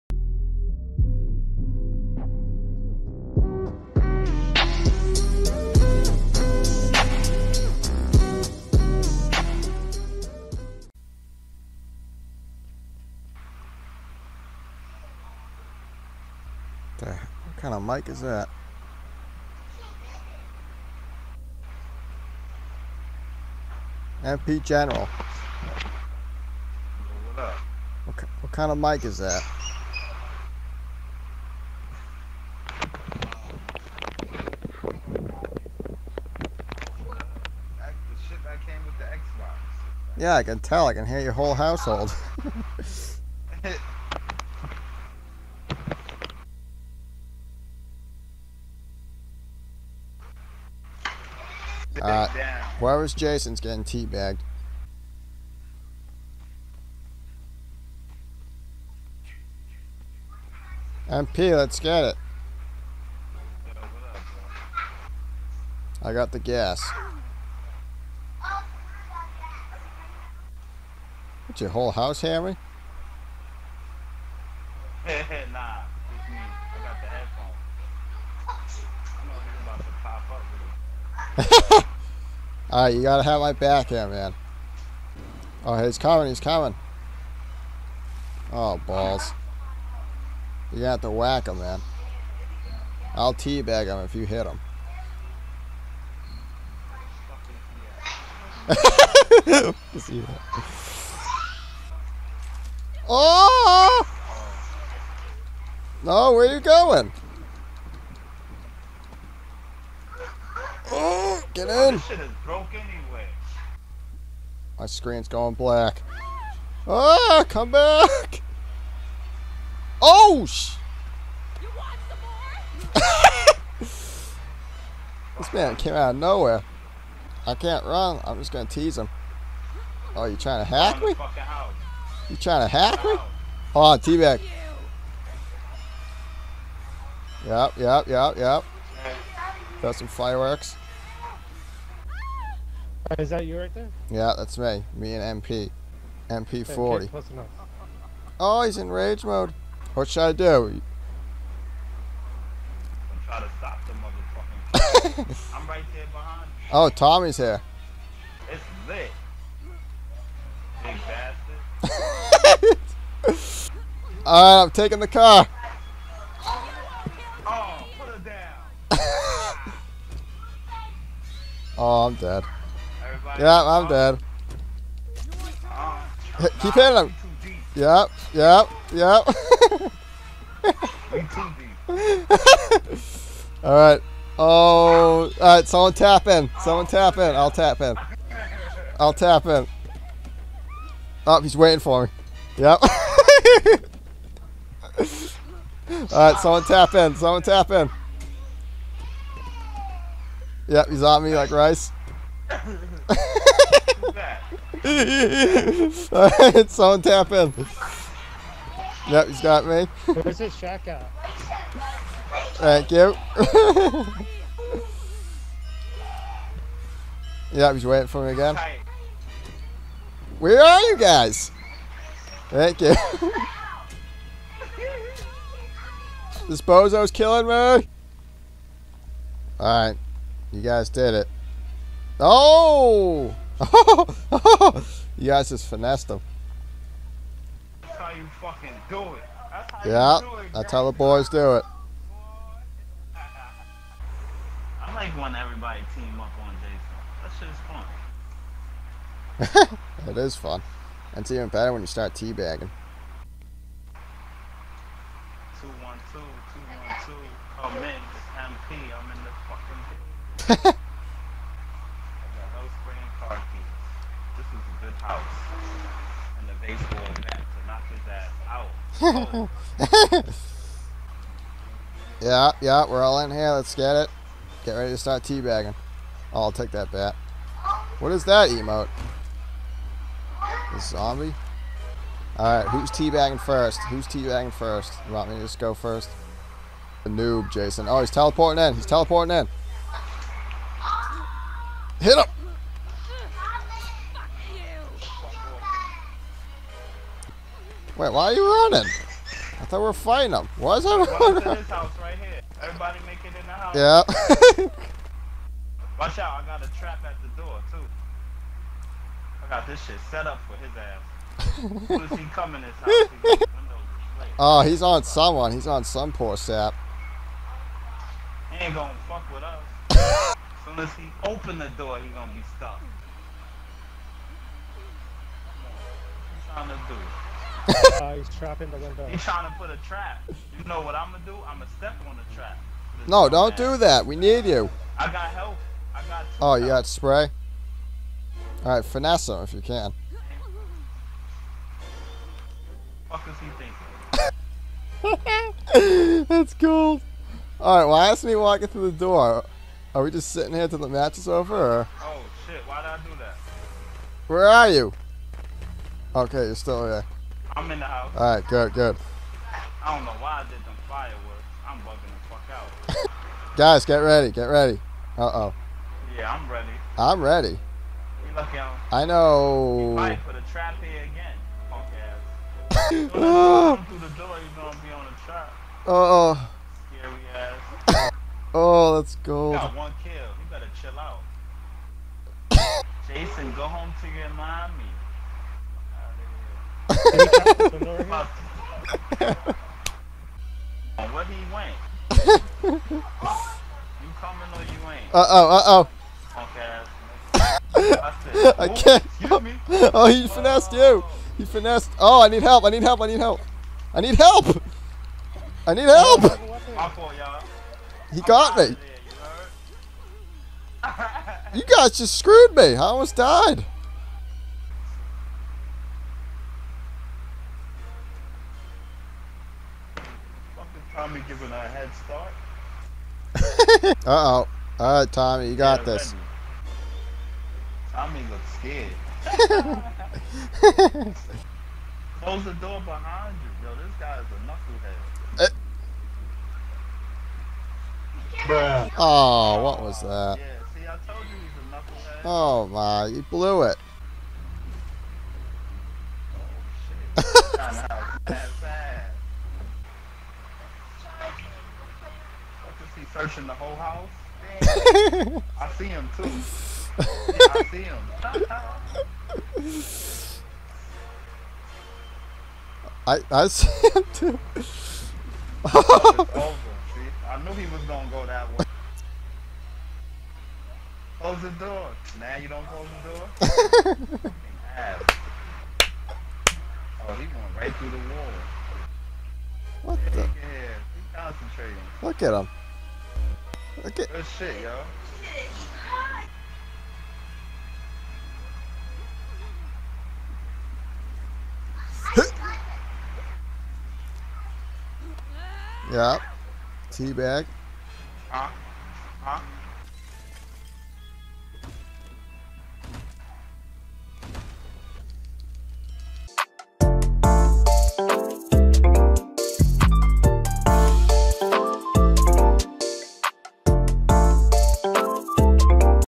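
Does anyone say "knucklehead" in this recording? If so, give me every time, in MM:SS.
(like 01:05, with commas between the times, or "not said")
07:15, 07:21.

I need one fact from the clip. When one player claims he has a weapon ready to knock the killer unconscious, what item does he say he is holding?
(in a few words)
baseball bat.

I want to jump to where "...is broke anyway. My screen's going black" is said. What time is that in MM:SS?
01:52.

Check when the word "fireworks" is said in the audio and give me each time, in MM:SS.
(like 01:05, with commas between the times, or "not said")
02:20, 06:00.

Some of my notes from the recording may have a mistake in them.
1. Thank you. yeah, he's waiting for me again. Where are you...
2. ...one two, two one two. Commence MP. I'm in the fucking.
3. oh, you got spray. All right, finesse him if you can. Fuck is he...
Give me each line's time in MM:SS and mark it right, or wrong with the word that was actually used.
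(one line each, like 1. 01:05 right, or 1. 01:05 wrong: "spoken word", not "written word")
1. 03:32 right
2. 04:15 right
3. 05:36 right.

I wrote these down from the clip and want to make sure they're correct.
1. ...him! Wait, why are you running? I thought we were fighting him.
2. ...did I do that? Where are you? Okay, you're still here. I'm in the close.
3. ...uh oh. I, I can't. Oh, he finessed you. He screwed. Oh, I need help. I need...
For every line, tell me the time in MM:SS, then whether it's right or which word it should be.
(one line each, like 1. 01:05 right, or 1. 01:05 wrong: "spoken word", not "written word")
1. 04:52 right
2. 05:52 wrong: "house", not "close"
3. 06:35 wrong: "finessed", not "screwed".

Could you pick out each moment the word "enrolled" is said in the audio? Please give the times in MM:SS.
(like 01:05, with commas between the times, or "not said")
not said.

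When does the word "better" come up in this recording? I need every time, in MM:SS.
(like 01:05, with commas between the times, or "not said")
04:11, 06:20.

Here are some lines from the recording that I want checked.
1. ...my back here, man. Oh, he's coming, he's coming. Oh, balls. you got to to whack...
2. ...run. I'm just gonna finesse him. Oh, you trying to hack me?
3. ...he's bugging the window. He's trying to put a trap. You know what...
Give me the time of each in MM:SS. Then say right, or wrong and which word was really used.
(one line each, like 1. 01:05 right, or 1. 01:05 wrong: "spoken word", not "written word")
1. 01:23 right
2. 02:07 wrong: "tease", not "finesse"
3. 05:28 wrong: "trapping", not "bugging".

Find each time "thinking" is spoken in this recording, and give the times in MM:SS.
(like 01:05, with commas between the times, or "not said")
05:45.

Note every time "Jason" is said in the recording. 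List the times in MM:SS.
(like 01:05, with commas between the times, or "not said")
00:53, 04:06, 04:47, 06:23.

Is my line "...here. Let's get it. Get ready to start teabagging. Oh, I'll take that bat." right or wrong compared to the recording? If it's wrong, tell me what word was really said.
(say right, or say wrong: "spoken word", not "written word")
right.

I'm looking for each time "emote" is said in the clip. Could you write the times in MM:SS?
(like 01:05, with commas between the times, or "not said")
04:38.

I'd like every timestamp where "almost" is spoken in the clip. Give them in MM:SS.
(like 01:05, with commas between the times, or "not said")
06:52.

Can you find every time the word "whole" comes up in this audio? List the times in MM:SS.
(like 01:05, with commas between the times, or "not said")
00:41, 01:11, 07:33.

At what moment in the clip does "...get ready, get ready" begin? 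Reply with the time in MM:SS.
06:03.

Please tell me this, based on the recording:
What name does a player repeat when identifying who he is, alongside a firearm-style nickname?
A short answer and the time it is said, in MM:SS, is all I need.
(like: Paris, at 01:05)
MP40, at 02:26.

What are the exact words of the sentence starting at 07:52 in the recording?
Now you don't close the door.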